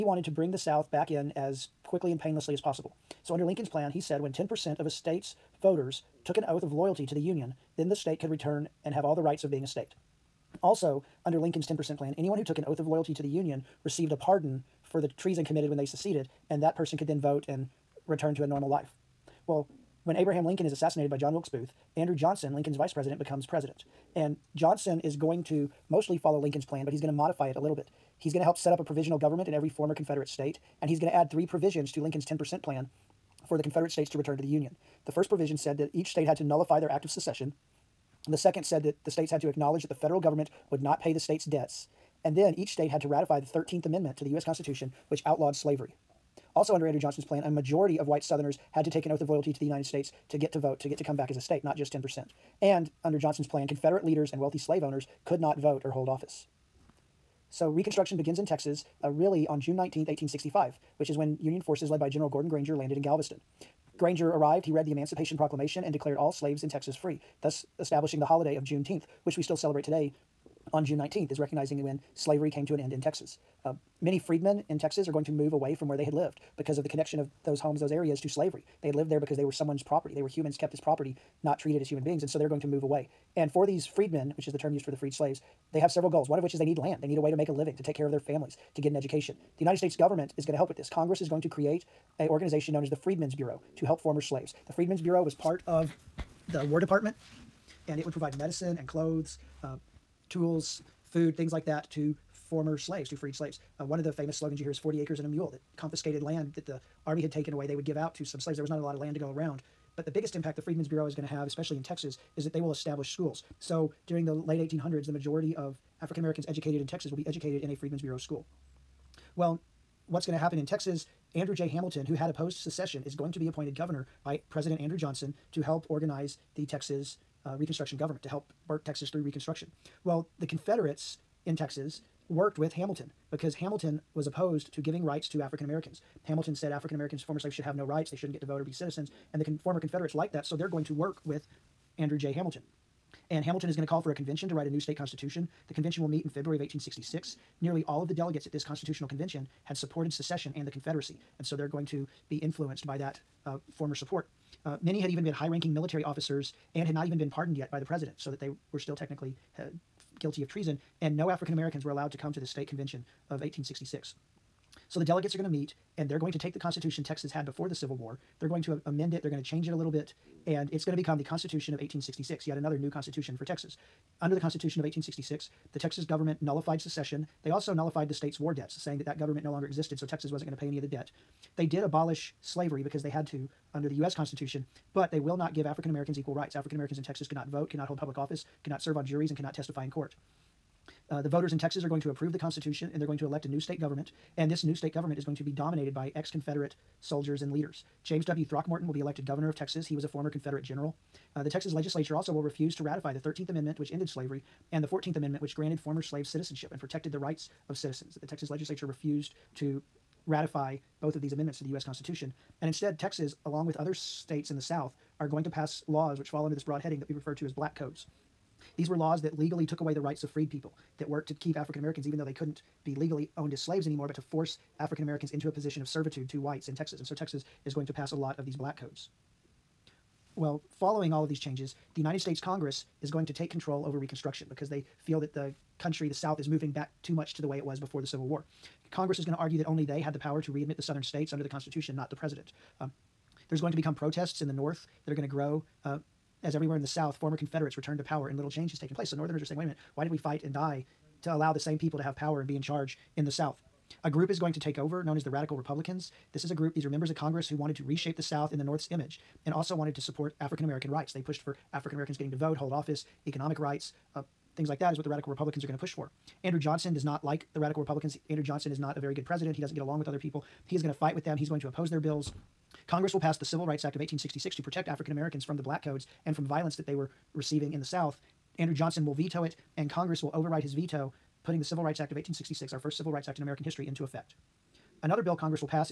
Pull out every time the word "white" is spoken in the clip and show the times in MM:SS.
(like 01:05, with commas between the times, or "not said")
00:48, 03:46.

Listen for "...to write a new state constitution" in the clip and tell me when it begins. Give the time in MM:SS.
02:24.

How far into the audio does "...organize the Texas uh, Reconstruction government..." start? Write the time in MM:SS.
02:05.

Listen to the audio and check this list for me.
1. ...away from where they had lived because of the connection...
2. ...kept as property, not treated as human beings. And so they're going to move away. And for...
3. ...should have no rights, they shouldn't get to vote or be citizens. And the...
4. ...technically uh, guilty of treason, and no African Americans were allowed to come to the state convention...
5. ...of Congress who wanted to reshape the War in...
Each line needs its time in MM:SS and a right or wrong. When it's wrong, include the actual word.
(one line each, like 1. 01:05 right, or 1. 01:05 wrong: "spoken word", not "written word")
1. 01:15 right
2. 01:20 right
3. 02:17 right
4. 02:38 right
5. 04:17 wrong: "South", not "War".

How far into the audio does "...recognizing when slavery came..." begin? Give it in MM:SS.
01:11.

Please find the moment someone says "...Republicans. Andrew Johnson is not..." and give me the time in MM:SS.
04:27.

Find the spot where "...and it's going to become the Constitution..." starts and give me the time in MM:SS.
02:50.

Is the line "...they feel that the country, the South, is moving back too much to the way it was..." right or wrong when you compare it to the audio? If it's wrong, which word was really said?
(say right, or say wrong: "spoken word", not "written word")
right.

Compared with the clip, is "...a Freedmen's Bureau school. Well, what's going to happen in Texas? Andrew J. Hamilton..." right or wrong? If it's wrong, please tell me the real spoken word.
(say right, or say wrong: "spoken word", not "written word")
right.